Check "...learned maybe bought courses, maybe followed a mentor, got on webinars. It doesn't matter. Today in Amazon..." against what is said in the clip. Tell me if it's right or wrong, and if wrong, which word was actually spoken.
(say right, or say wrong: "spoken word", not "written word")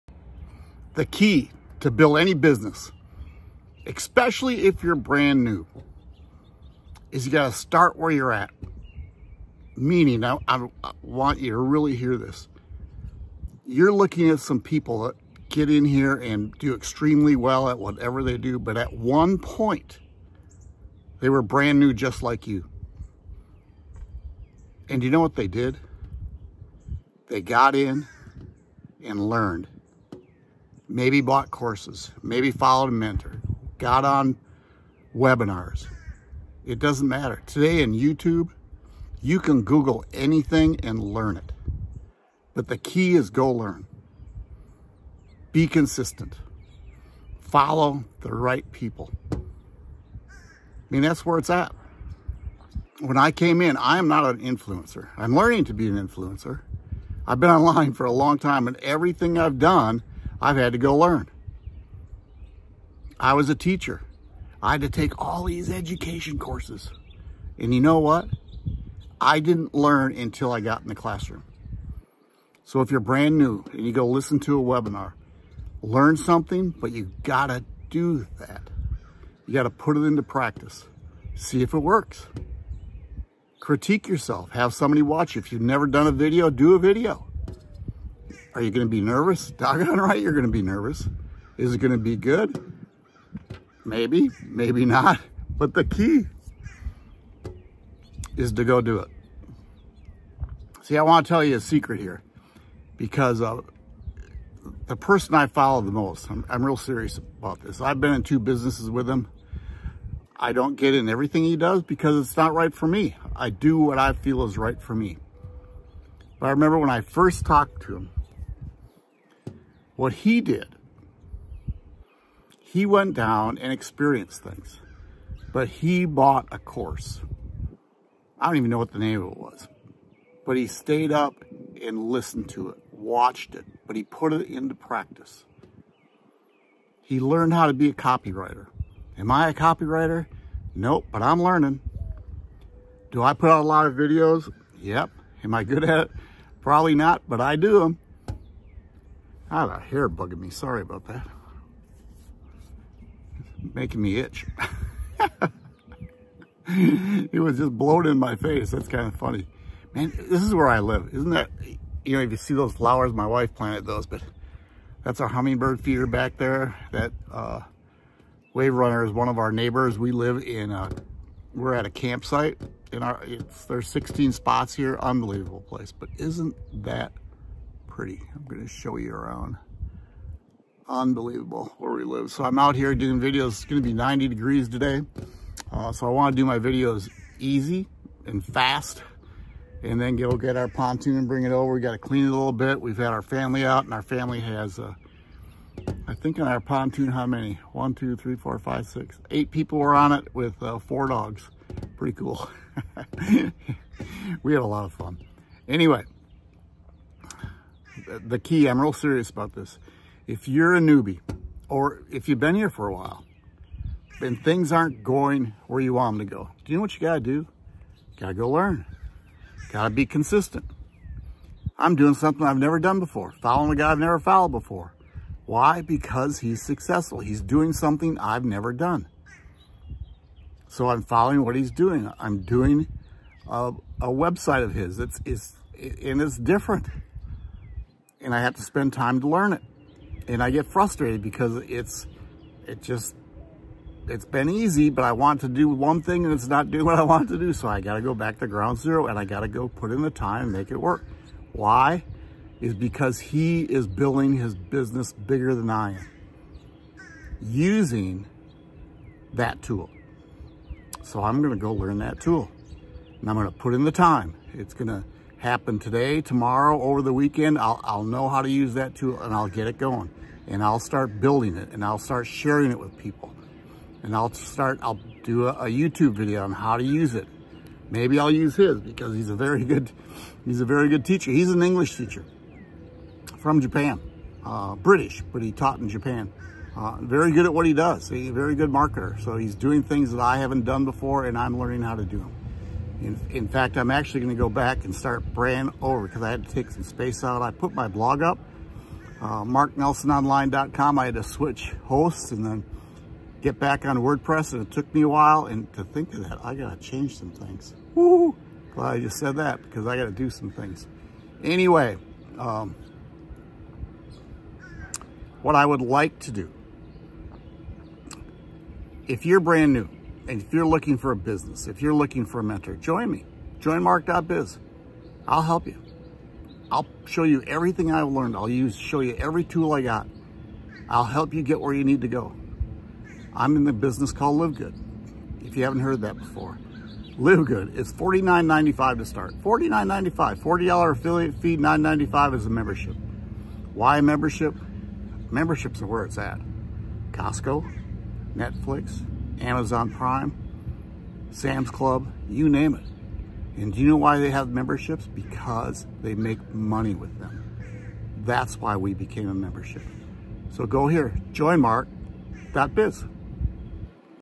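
wrong: "YouTube", not "Amazon".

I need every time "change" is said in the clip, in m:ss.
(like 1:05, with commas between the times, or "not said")
5:06.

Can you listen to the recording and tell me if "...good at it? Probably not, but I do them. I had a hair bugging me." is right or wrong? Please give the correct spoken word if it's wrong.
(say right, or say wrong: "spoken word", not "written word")
right.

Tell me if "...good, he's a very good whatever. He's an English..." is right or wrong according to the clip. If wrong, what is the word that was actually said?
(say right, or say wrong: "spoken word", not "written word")
wrong: "teacher", not "whatever".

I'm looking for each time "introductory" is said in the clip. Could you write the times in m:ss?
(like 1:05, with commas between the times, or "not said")
not said.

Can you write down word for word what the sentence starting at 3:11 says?
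We got to clean it a little bit.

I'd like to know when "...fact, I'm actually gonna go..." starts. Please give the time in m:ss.
4:53.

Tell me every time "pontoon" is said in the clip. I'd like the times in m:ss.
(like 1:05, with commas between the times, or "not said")
3:10, 3:16.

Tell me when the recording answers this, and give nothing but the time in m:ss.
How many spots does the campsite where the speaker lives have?
2:53.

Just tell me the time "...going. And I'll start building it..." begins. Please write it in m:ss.
4:29.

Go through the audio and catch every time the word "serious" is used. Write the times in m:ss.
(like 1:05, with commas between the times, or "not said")
1:46, 3:28.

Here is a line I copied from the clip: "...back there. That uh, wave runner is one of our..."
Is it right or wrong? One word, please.
right.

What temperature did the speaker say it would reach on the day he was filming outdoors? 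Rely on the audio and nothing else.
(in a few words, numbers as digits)
90 degrees.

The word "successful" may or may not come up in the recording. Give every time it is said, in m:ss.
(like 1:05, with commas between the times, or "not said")
3:46.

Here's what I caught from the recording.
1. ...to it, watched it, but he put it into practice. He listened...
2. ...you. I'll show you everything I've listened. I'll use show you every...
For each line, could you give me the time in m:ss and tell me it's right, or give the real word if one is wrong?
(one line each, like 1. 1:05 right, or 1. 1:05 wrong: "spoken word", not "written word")
1. 2:12 wrong: "learned", not "listened"
2. 5:25 wrong: "learned", not "listened".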